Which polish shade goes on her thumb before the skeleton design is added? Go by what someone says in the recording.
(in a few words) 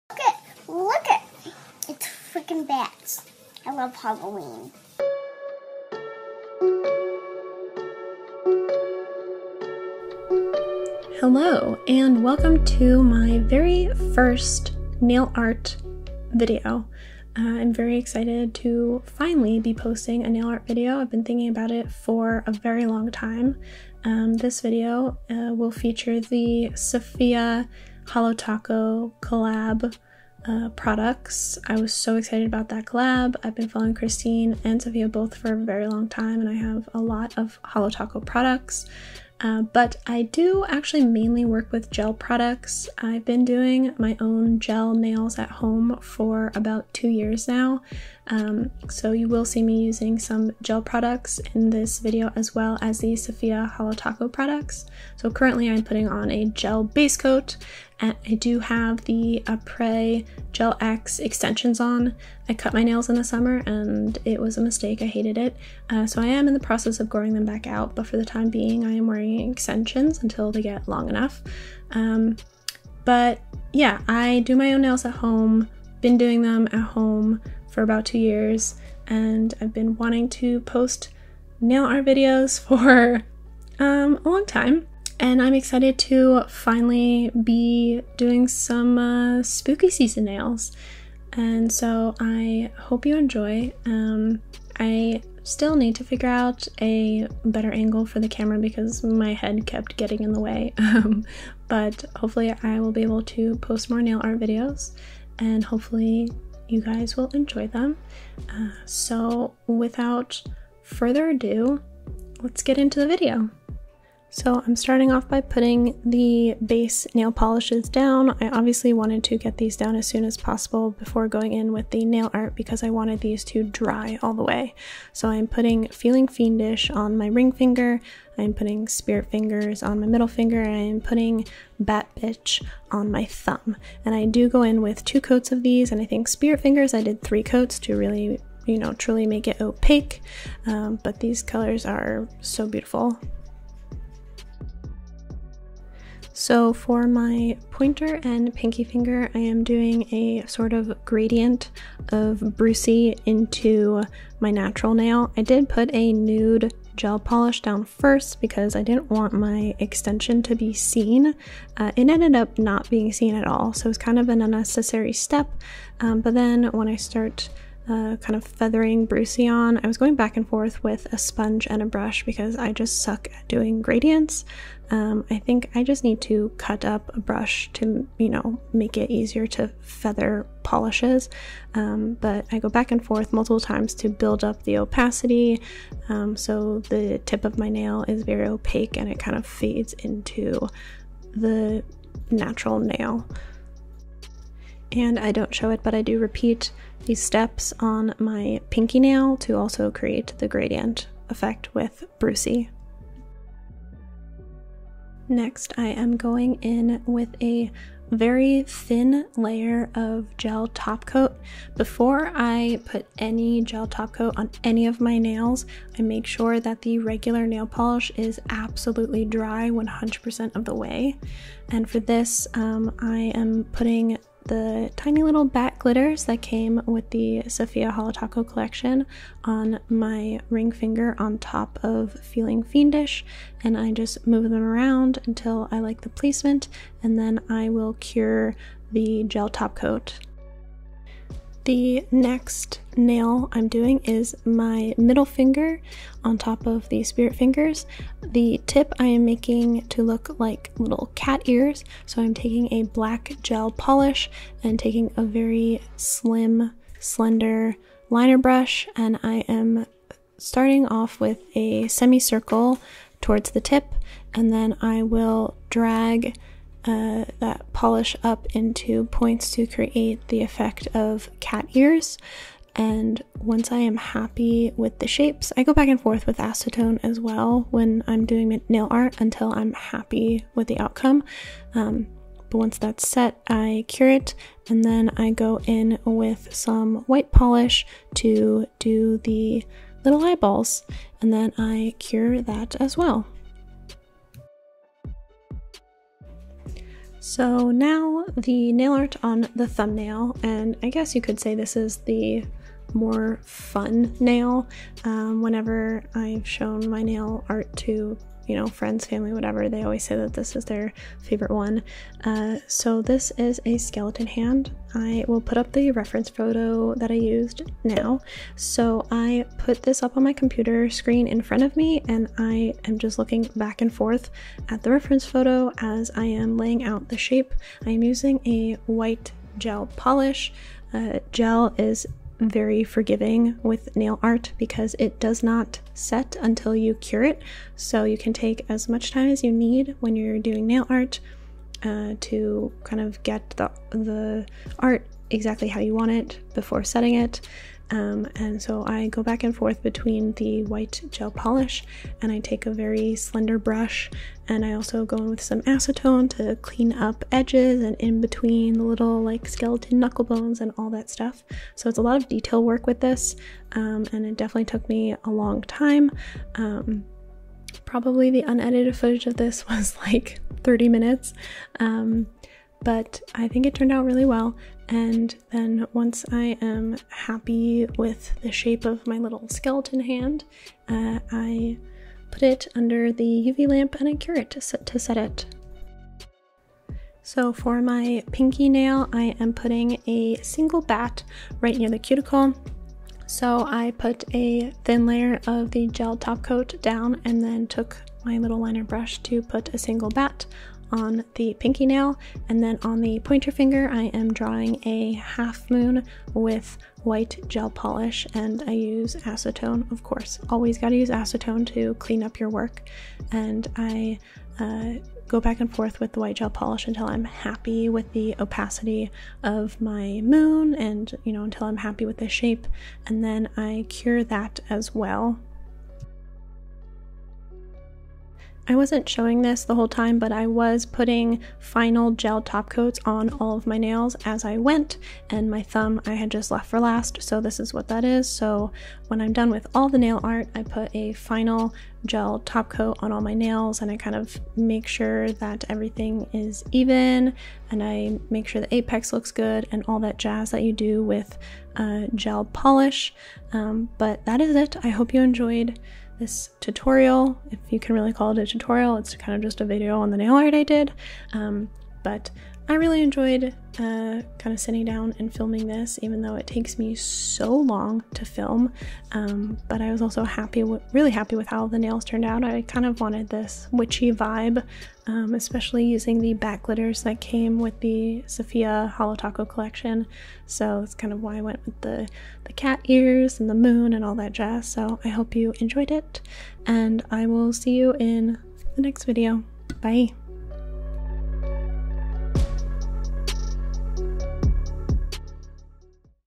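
Bat Bitch.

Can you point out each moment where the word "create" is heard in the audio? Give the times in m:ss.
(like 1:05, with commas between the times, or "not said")
3:19, 4:29.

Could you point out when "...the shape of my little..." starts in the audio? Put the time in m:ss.
6:18.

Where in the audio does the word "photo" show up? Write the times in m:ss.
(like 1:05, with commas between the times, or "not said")
5:16, 5:25.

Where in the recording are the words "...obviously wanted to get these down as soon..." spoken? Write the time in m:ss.
1:58.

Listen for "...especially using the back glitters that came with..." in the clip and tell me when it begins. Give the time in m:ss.
7:55.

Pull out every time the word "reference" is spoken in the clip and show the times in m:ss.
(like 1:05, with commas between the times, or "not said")
5:15, 5:24.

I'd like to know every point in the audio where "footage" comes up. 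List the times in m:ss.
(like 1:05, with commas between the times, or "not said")
6:08.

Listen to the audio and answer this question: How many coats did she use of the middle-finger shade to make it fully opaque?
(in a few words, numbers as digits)
3.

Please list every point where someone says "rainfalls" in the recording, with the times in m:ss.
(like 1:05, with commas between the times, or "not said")
not said.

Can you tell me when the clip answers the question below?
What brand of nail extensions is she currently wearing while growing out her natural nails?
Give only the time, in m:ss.
0:59.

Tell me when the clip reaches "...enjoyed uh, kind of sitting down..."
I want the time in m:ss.
7:43.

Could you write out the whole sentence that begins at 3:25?
Next, I am going in with a very thin layer of gel top coat.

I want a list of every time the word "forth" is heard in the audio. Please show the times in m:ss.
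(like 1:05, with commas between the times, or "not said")
2:50, 3:03, 4:35, 5:23, 5:49, 6:55.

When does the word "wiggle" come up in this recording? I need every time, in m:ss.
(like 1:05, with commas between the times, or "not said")
not said.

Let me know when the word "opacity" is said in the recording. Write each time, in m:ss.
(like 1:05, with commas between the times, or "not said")
3:04, 6:58.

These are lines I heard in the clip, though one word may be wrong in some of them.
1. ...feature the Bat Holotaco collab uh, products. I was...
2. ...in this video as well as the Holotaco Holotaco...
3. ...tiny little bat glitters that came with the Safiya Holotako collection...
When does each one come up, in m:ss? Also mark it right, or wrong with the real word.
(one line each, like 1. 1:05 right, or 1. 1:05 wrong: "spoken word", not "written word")
1. 0:25 wrong: "Safiya", not "Bat"
2. 0:51 wrong: "Safiya", not "Holotaco"
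3. 3:44 right.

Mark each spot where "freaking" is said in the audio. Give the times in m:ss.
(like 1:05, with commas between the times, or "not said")
0:02.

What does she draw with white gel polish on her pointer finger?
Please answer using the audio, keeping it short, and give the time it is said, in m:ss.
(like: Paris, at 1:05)
A half moon, at 6:45.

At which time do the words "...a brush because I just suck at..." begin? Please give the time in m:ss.
2:51.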